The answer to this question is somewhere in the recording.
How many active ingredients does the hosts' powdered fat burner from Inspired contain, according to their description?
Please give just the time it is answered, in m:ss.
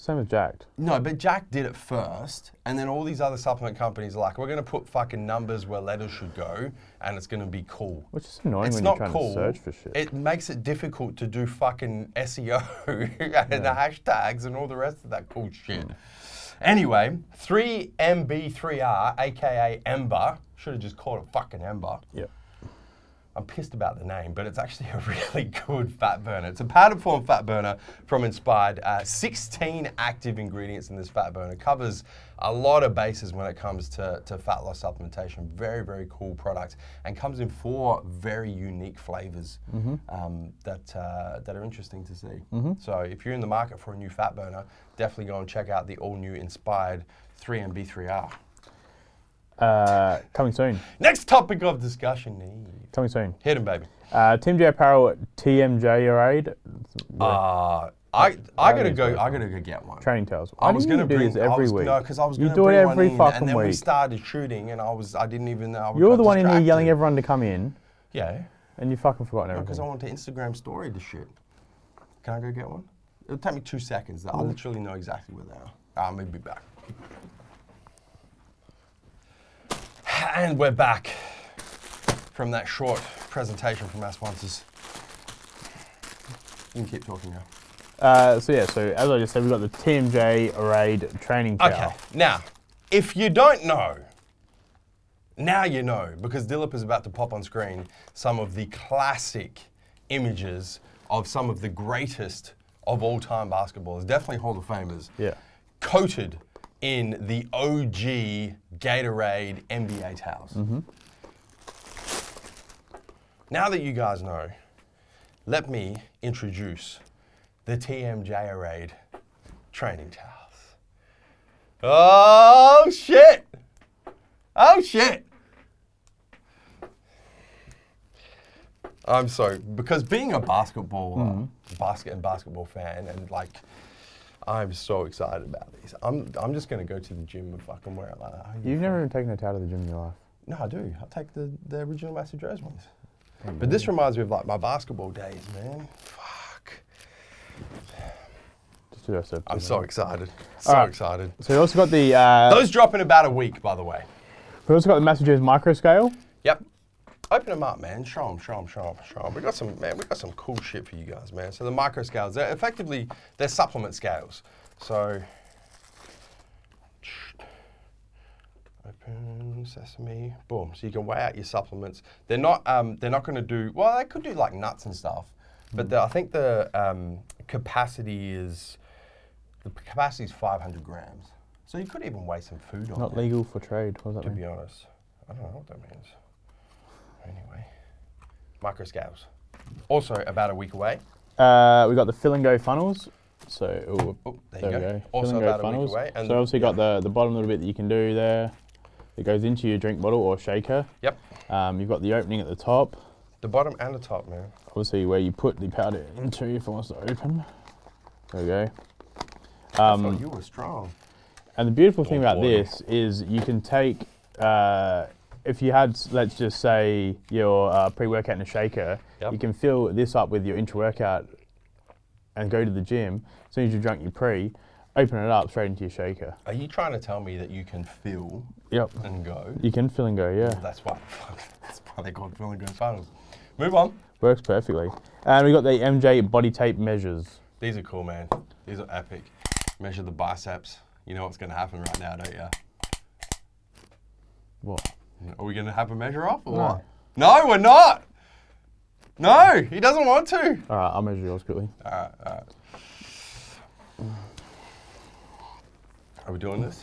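0:29.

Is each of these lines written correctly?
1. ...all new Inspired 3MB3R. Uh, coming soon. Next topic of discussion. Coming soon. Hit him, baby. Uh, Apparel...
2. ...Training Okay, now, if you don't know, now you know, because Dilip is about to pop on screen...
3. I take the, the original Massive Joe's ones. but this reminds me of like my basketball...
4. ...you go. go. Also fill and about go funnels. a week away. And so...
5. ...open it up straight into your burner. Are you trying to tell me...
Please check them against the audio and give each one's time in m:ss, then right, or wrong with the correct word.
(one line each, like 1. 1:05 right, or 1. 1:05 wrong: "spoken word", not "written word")
1. 0:46 wrong: "TMJ", not "Apparel"
2. 1:31 right
3. 2:20 right
4. 3:14 right
5. 3:44 wrong: "shaker", not "burner".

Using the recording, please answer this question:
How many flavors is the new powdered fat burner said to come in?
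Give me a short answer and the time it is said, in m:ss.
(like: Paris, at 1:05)
4, at 0:37.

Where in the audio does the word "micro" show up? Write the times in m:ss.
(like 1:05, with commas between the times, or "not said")
2:35, 2:41.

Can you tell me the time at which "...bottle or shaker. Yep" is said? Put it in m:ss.
3:19.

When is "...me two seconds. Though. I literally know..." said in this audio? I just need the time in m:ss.
1:13.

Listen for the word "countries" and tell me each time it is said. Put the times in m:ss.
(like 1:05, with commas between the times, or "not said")
not said.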